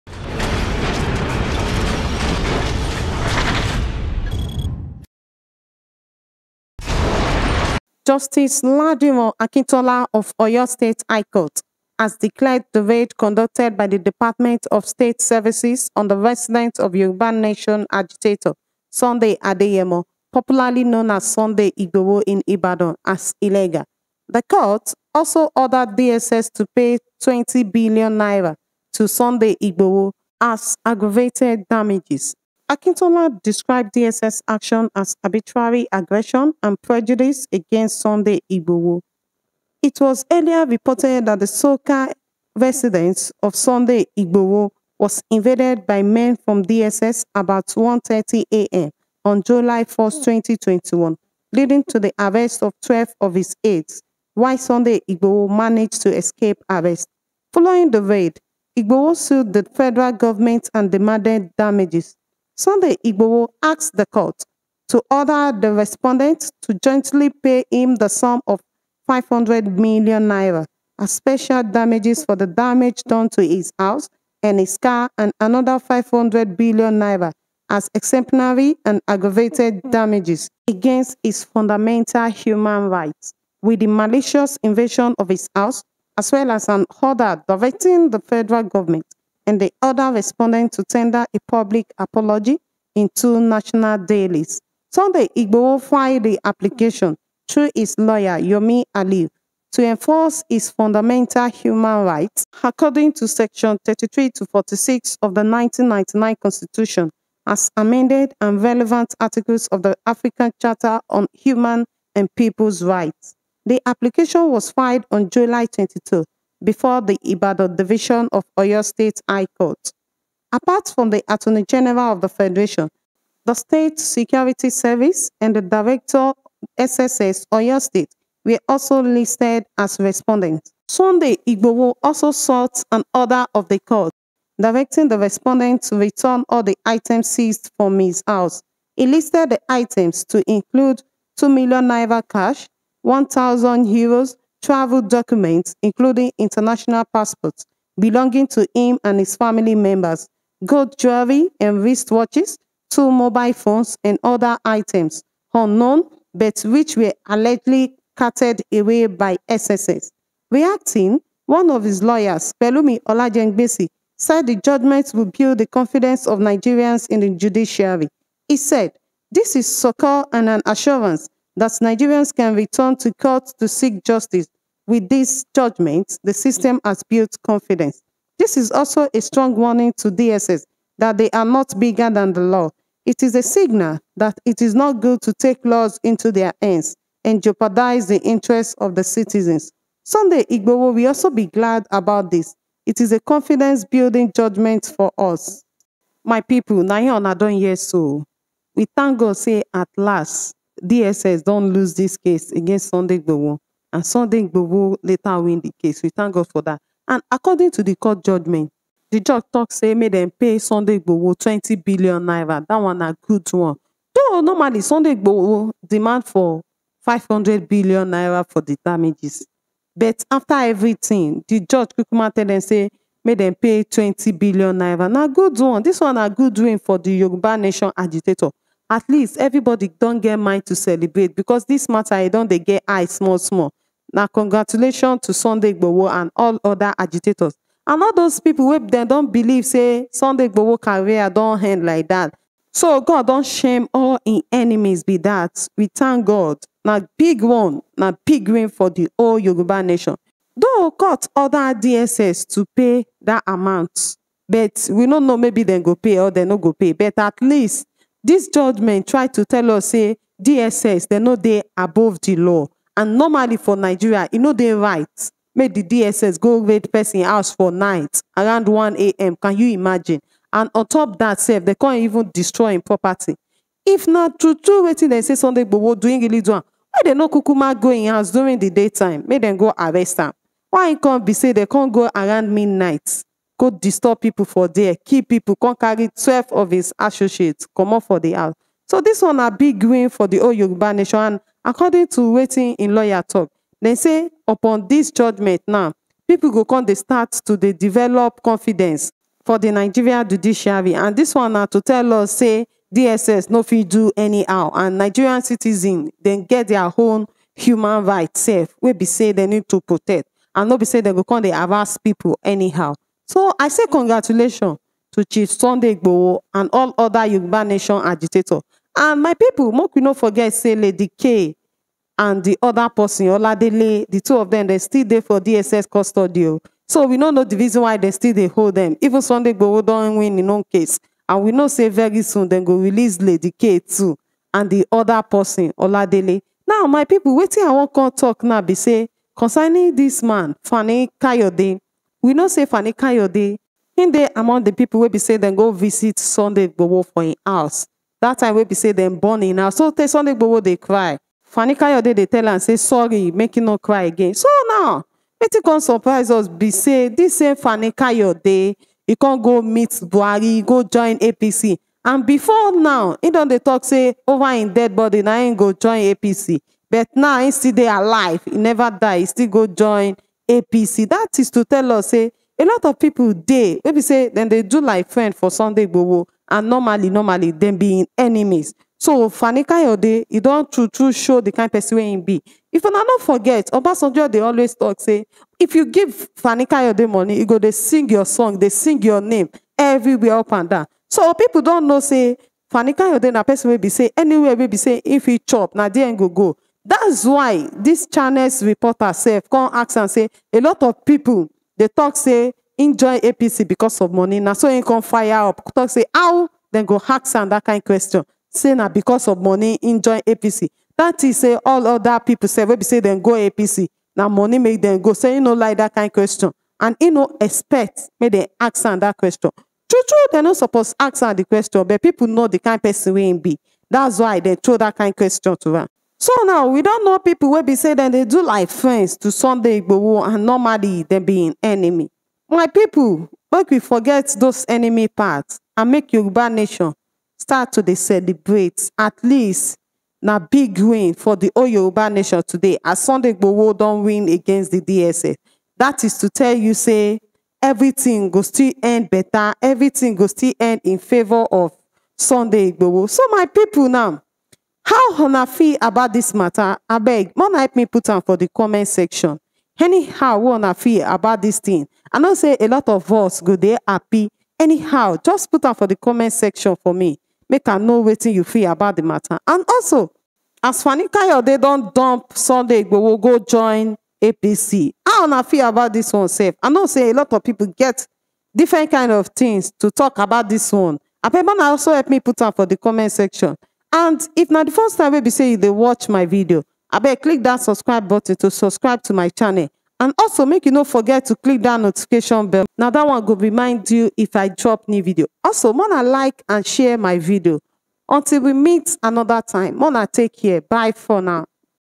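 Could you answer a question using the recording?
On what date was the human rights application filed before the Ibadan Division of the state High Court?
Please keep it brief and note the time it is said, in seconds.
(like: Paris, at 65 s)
July 22, at 115 s.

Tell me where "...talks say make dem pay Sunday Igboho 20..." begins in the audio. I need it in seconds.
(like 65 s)
209 s.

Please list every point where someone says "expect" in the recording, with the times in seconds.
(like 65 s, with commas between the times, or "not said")
417 s.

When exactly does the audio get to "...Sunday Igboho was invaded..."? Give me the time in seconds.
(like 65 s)
43 s.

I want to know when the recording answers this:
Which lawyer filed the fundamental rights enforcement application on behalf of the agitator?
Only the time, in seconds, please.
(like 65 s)
98 s.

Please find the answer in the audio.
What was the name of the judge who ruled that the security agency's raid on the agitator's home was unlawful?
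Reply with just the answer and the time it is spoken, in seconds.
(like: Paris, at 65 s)
Ladimo Akintola, at 8 s.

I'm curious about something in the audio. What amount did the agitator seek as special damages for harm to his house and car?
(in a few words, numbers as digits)
500 million naira.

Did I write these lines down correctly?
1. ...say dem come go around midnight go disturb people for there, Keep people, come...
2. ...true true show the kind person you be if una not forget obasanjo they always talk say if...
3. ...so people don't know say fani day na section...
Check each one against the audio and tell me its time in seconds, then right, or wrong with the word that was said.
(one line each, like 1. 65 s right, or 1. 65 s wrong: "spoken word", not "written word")
1. 281 s right
2. 380 s right
3. 391 s wrong: "person", not "section".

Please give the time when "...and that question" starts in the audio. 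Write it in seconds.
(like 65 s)
418 s.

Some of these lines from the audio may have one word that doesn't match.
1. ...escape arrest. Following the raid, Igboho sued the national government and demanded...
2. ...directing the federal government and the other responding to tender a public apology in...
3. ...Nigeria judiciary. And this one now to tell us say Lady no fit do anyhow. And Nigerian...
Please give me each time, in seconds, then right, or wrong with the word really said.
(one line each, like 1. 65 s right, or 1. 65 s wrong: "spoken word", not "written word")
1. 56 s wrong: "federal", not "national"
2. 87 s right
3. 299 s wrong: "DSS", not "Lady".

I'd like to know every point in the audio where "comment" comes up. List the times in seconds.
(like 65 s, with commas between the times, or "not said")
458 s, 465 s, 482 s.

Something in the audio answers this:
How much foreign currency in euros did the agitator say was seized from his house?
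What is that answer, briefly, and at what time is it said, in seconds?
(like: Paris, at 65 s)
1,000 euros, at 143 s.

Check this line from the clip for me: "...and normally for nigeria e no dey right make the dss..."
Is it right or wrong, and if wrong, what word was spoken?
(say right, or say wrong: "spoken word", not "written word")
right.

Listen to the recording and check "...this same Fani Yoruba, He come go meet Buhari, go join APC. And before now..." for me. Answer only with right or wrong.
wrong.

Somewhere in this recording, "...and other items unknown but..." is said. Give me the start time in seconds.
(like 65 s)
154 s.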